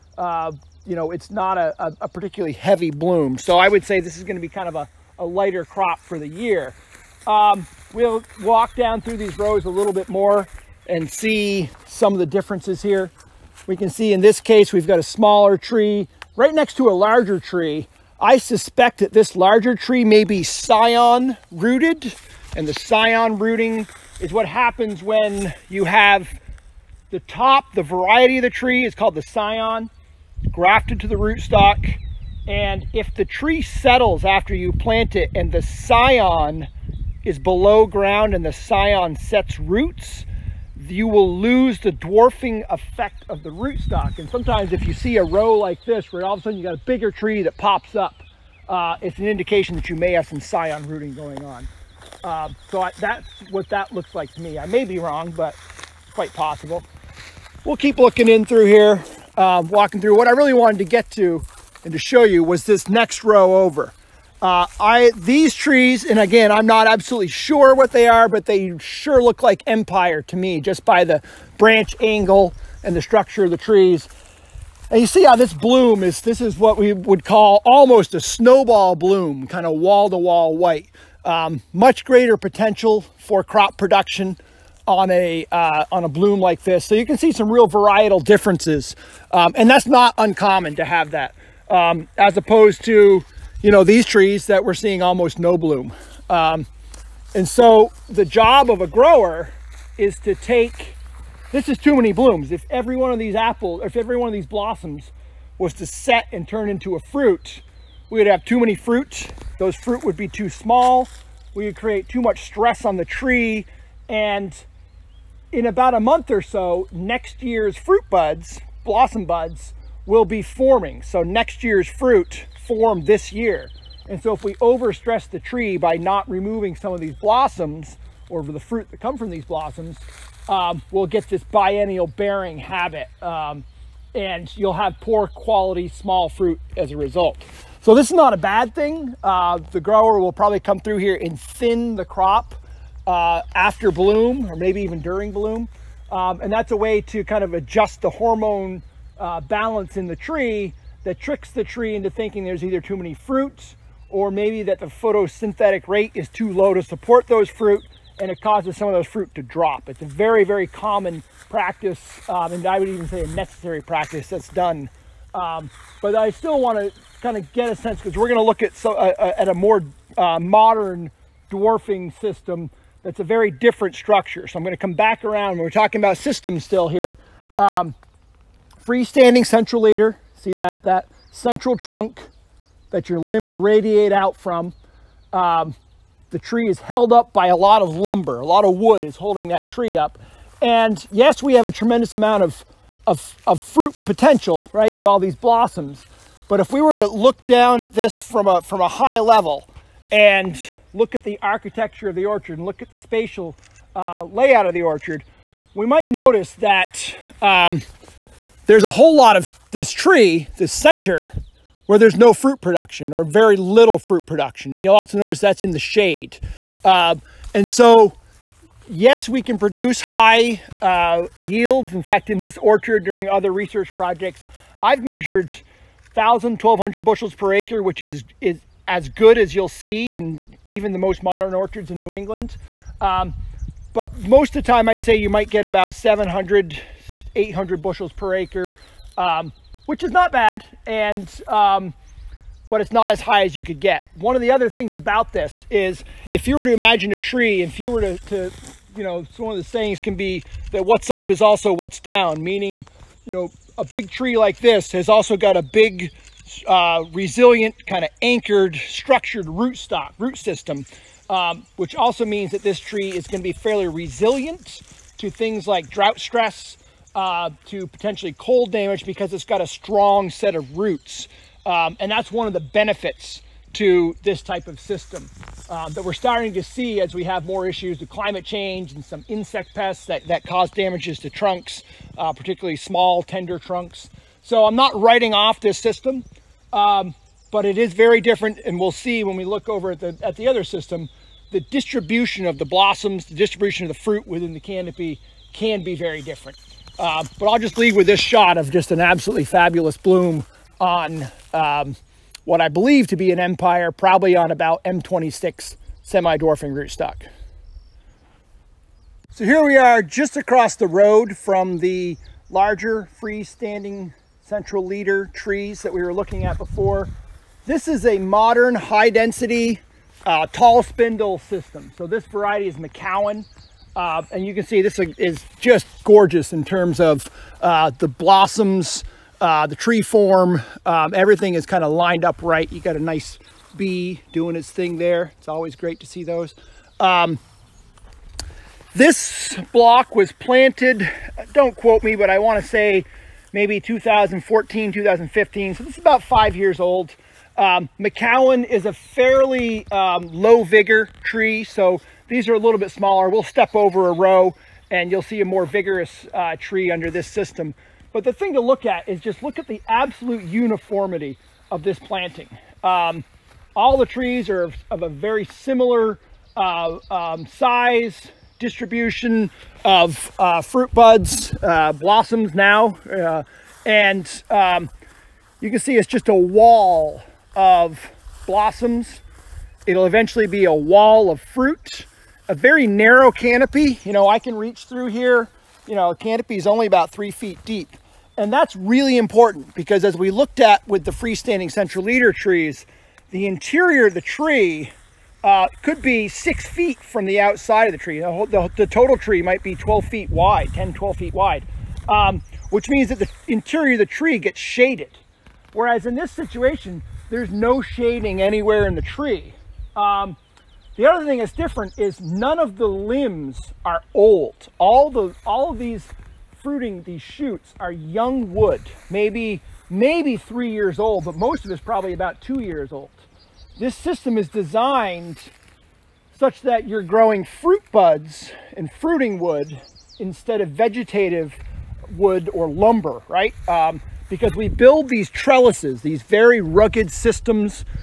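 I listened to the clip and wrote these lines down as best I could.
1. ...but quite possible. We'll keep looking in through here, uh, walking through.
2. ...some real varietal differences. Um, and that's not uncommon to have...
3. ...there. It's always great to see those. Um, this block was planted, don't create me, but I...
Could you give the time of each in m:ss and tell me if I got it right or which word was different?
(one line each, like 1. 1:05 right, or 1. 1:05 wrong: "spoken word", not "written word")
1. 0:55 right
2. 1:27 right
3. 5:34 wrong: "quote", not "create".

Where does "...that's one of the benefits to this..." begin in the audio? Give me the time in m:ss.
4:32.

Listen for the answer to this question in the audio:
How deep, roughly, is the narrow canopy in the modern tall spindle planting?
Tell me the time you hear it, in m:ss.
6:26.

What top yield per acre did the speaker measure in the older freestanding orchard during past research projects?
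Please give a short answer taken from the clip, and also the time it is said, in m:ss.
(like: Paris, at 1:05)
1,200 bushels, at 3:46.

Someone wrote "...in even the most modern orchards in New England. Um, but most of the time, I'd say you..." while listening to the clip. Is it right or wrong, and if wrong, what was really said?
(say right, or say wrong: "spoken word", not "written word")
right.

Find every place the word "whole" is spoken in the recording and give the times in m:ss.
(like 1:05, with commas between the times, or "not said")
3:28, 6:38.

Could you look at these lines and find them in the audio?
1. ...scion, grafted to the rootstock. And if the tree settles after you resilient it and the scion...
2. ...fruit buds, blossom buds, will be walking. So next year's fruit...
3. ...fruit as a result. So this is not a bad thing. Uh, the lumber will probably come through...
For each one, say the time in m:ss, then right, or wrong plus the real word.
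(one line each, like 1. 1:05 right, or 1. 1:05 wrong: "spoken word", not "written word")
1. 0:29 wrong: "plant", not "resilient"
2. 1:57 wrong: "forming", not "walking"
3. 2:16 wrong: "grower", not "lumber".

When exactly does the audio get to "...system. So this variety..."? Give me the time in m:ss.
5:21.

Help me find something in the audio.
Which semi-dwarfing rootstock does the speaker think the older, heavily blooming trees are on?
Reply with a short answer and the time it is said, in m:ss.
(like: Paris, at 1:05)
M26, at 5:04.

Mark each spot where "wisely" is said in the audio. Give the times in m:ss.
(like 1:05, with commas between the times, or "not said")
not said.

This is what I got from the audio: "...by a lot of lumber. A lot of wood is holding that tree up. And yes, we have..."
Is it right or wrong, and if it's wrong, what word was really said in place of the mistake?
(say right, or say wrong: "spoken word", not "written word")
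right.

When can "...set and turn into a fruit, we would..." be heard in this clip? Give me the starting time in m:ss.
1:45.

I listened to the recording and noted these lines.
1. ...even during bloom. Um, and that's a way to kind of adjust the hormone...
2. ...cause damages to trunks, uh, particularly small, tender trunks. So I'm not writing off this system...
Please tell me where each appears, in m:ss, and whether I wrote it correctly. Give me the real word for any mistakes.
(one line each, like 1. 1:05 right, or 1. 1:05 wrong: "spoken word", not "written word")
1. 2:24 right
2. 4:40 right.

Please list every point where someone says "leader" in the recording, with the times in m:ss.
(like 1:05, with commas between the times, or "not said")
2:59, 5:14, 6:32.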